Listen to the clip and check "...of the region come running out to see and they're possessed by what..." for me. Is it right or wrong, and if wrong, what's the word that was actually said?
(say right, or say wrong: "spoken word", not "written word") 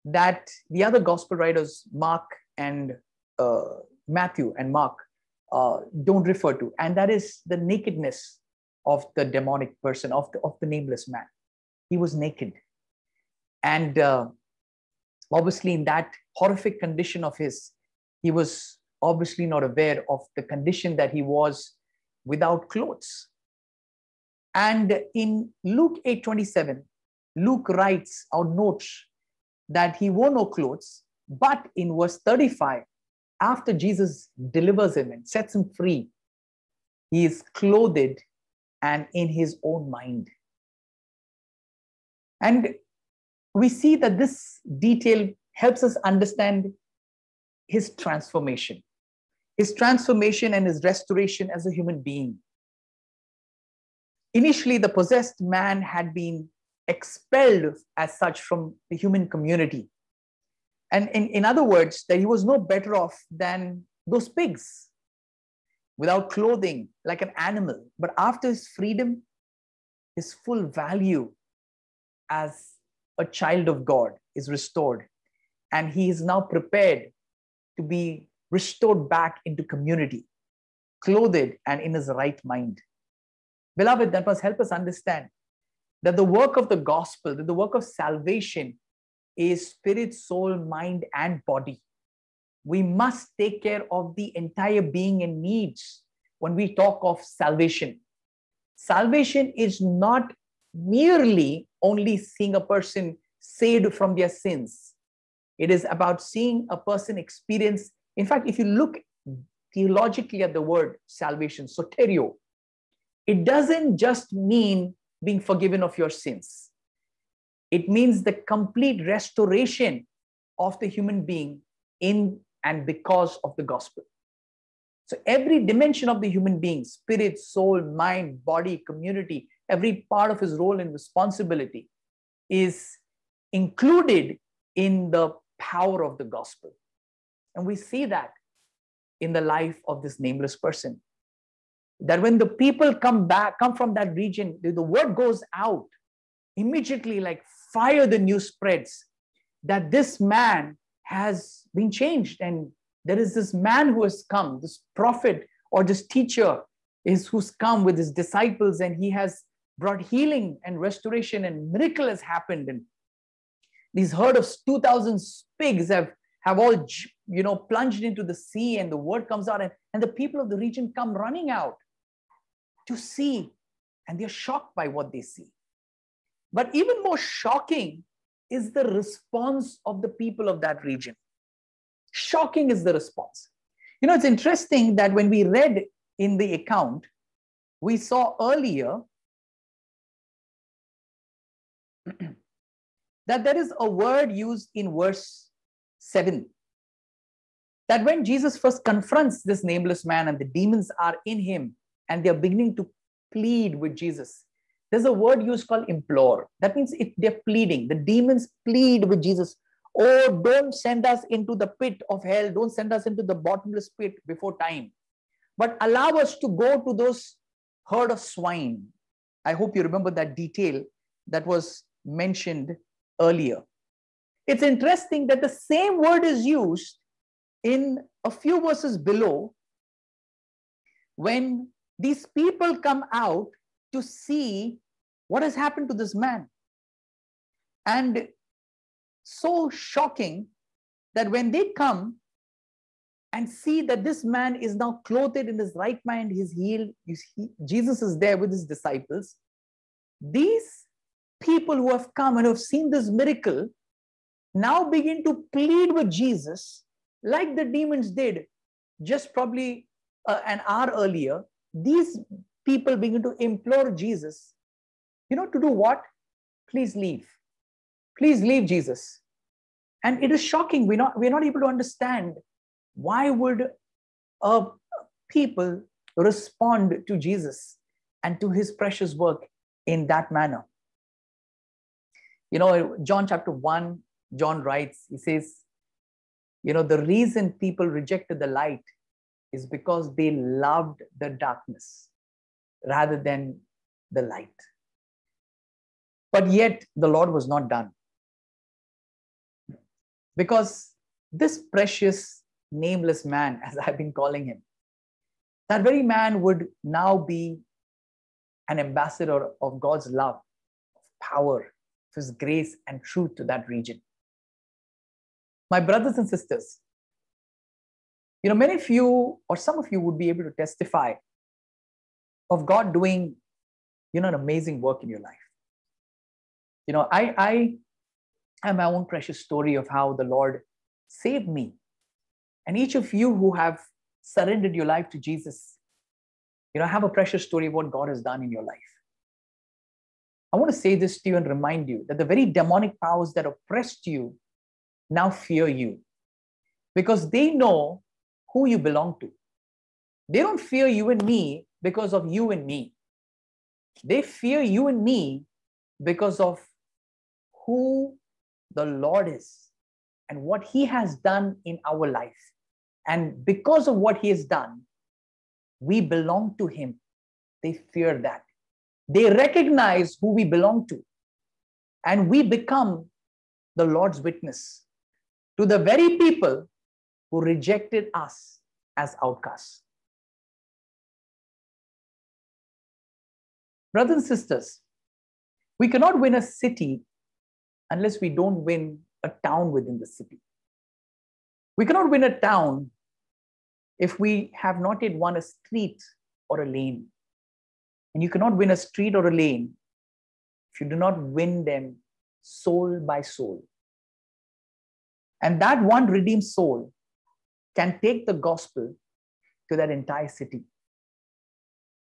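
wrong: "shocked", not "possessed".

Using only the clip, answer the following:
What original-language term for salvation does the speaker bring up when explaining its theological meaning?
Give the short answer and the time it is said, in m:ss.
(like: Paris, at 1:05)
soterio, at 1:51.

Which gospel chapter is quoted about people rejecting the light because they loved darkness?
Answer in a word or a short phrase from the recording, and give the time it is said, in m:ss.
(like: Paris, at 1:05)
John chapter 1, at 4:43.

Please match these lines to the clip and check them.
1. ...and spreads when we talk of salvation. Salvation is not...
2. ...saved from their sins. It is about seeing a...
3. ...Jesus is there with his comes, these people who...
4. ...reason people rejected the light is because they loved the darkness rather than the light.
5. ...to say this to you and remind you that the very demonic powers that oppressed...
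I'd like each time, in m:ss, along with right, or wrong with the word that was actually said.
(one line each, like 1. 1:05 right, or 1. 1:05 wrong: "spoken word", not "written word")
1. 1:35 wrong: "needs", not "spreads"
2. 1:43 right
3. 4:07 wrong: "disciples", not "comes"
4. 4:47 right
5. 5:40 right.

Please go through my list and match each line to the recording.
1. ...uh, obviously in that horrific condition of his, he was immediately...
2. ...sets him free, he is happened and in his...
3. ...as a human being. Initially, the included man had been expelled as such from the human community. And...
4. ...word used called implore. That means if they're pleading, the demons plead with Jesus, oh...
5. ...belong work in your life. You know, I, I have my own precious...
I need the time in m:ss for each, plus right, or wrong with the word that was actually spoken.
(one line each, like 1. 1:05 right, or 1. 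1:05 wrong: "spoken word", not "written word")
1. 0:13 wrong: "obviously", not "immediately"
2. 0:35 wrong: "clothed", not "happened"
3. 0:51 wrong: "possessed", not "included"
4. 3:25 right
5. 5:24 wrong: "amazing", not "belong".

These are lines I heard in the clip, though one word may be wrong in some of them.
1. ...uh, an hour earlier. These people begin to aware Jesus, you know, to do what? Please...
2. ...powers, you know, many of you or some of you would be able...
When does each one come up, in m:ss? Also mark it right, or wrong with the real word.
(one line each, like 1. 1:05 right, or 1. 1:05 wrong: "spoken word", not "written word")
1. 4:20 wrong: "implore", not "aware"
2. 5:16 wrong: "sisters", not "powers".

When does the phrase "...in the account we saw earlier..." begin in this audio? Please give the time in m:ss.
3:06.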